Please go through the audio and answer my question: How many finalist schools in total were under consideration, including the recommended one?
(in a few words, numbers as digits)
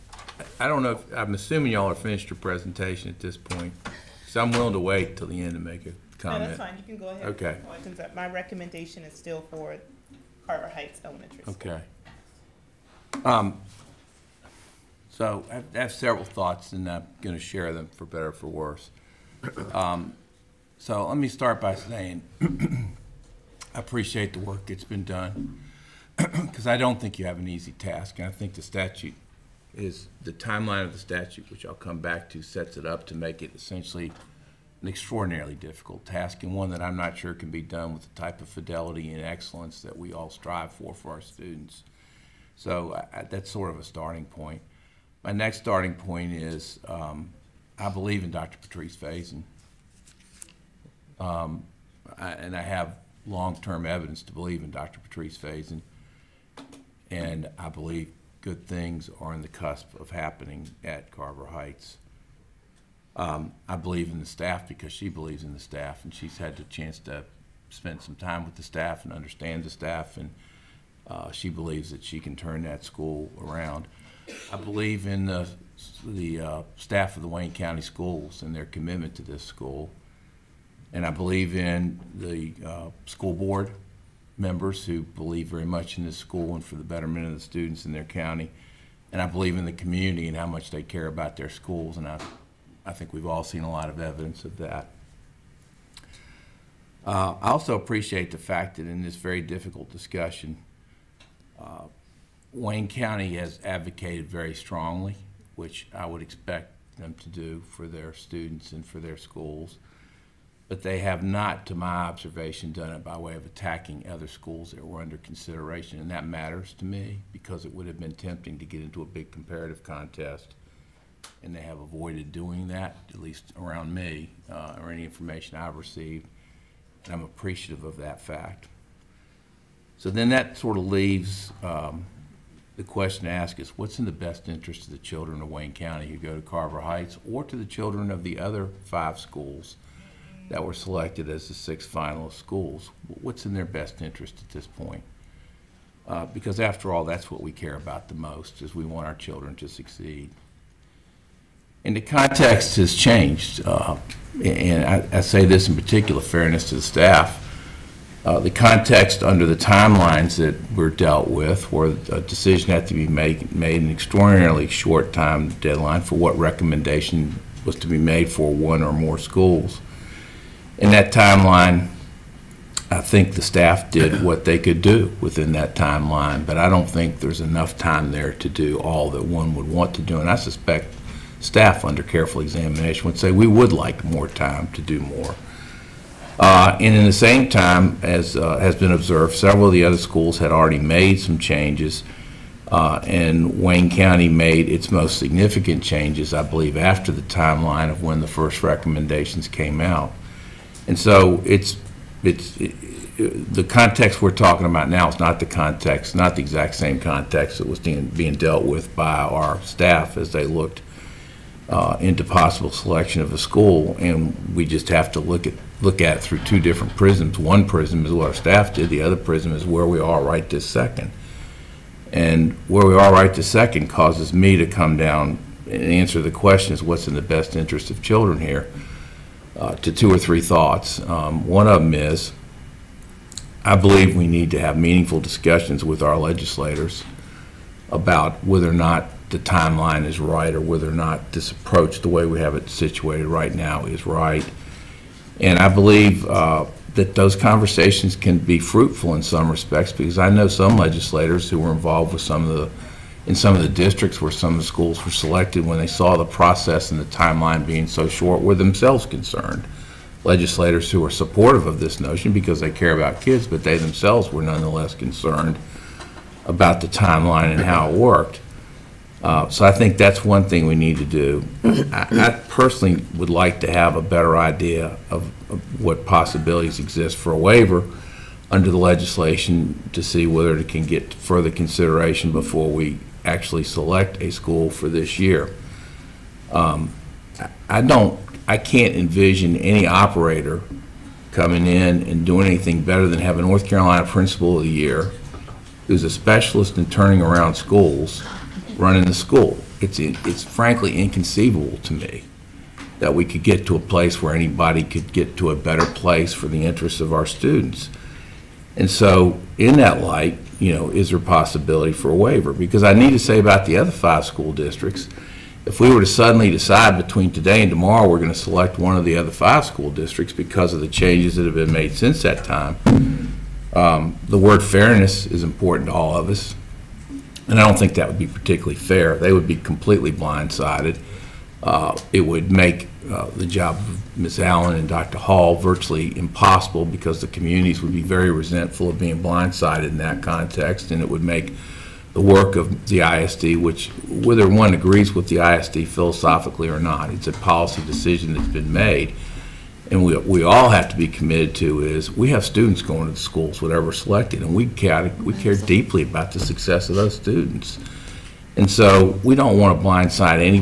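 6.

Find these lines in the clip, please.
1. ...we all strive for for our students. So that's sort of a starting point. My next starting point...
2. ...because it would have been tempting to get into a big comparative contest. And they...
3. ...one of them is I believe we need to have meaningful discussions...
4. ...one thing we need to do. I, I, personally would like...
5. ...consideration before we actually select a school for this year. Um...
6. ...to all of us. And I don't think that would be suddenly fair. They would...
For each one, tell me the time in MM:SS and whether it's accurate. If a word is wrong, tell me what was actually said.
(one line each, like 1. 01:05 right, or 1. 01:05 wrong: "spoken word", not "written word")
1. 00:39 right
2. 01:57 right
3. 03:51 right
4. 04:30 right
5. 04:41 right
6. 05:25 wrong: "particularly", not "suddenly".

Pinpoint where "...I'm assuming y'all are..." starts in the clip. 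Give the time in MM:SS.
00:01.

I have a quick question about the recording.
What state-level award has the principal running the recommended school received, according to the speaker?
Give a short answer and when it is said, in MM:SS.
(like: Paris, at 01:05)
North Carolina Principal of the Year, at 04:53.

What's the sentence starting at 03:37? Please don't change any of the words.
One prism is what our staff did, the other prism is where we are right this second.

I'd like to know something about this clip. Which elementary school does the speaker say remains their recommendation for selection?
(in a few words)
Carver Heights Elementary School.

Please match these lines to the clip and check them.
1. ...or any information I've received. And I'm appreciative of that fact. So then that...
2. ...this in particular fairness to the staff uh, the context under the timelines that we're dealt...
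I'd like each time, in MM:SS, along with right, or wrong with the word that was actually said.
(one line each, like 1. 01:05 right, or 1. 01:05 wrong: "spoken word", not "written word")
1. 02:04 right
2. 02:35 right.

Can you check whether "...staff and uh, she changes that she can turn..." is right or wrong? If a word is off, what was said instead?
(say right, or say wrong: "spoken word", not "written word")
wrong: "believes", not "changes".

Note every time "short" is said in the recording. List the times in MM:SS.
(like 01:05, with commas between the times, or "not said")
02:44, 04:18.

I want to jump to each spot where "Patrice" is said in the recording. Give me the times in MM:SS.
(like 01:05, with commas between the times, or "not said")
00:48, 00:54.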